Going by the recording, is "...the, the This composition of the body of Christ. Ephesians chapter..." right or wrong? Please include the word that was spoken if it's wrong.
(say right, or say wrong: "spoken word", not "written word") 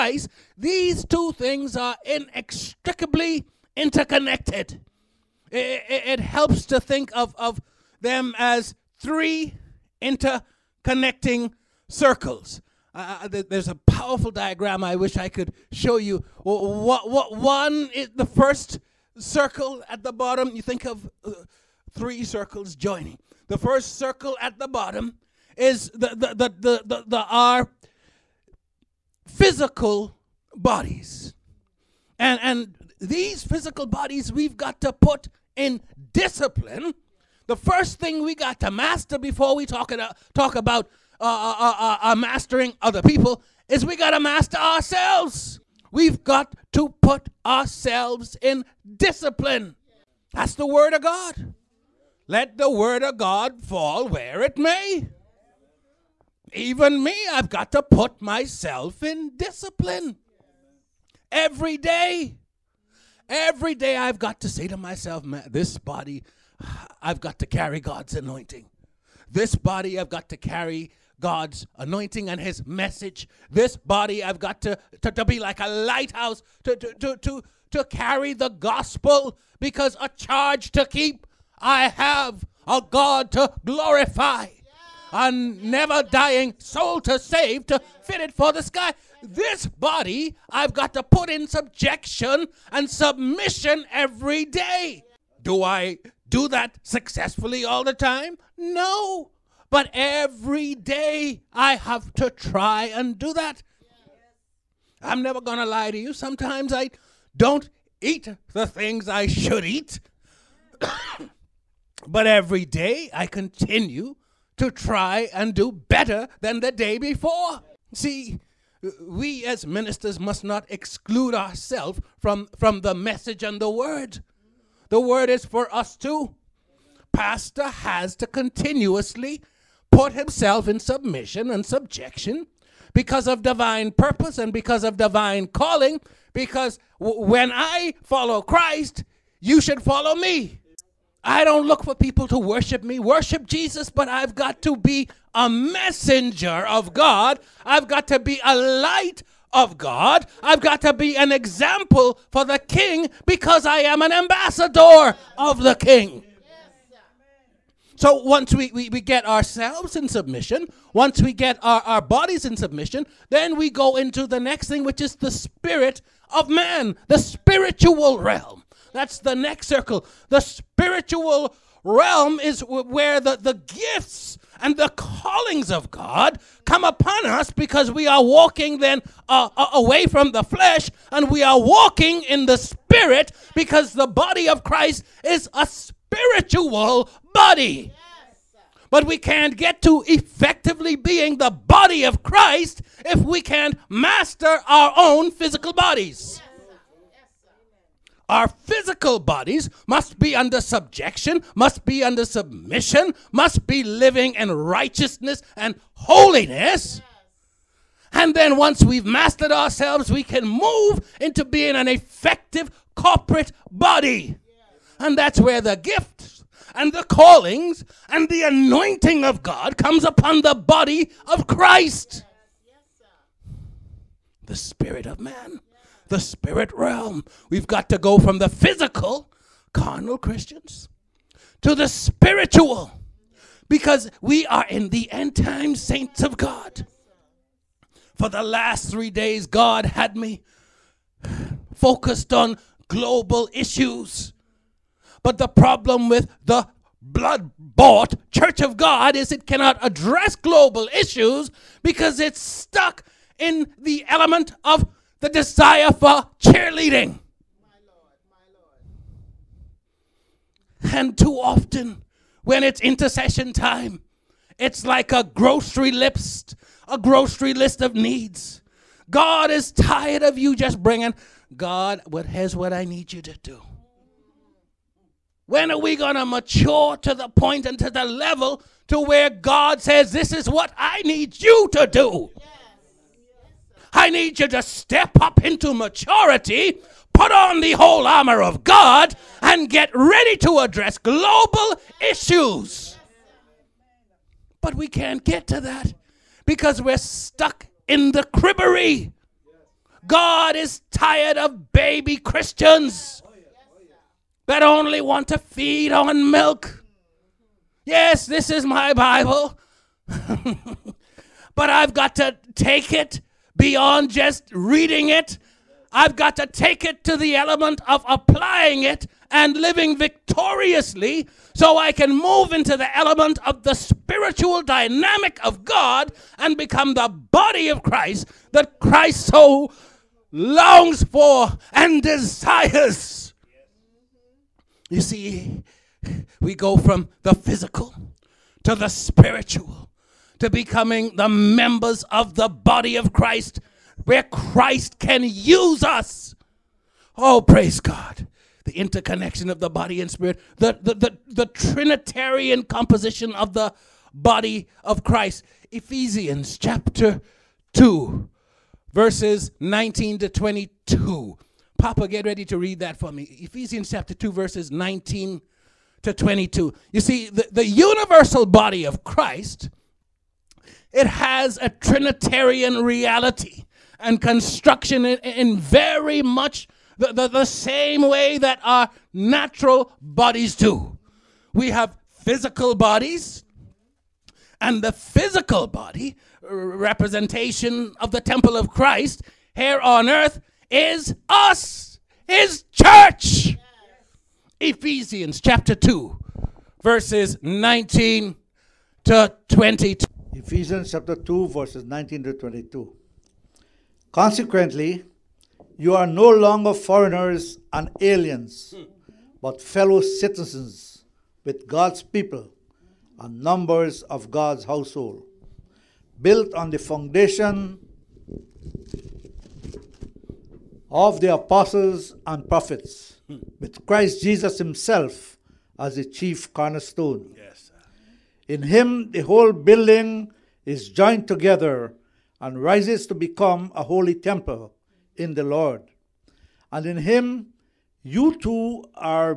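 wrong: "Trinitarian", not "This".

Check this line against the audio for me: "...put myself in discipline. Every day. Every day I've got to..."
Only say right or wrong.
right.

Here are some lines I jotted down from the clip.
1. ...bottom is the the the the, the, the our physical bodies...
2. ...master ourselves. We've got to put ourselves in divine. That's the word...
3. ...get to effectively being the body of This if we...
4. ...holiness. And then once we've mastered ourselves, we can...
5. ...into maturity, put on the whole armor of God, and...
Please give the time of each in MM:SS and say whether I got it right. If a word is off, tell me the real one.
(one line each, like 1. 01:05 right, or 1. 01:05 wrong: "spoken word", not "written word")
1. 00:24 right
2. 00:44 wrong: "discipline", not "divine"
3. 03:09 wrong: "Christ", not "This"
4. 03:25 right
5. 04:45 right.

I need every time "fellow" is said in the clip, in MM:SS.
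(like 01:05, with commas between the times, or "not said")
06:49.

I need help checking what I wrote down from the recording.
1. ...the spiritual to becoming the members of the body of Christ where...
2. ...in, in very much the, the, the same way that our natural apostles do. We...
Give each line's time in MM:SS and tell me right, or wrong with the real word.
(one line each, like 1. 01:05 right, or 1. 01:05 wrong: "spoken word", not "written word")
1. 05:38 right
2. 06:15 wrong: "bodies", not "apostles".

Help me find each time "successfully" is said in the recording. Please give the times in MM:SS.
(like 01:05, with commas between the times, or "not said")
01:36.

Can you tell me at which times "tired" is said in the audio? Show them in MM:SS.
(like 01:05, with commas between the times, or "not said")
04:29, 05:00.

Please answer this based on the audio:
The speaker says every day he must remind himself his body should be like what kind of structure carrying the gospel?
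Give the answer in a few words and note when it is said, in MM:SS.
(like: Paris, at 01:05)
a lighthouse, at 01:15.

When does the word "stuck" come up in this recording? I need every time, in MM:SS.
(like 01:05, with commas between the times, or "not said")
04:12, 04:56.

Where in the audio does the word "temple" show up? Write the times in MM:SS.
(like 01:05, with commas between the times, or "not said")
06:28, 07:14.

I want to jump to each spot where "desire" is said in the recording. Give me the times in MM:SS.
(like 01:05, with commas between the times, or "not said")
04:15, 05:32.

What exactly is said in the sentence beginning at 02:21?
I don't look for people to worship me, worship Jesus, but I've got to be a messenger of God.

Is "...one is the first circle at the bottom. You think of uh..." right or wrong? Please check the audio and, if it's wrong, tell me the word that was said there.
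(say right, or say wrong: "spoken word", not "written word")
right.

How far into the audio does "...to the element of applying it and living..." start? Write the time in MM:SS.
05:17.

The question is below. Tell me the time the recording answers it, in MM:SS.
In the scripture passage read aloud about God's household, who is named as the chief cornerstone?
07:03.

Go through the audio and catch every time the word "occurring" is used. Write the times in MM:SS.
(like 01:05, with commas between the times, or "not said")
not said.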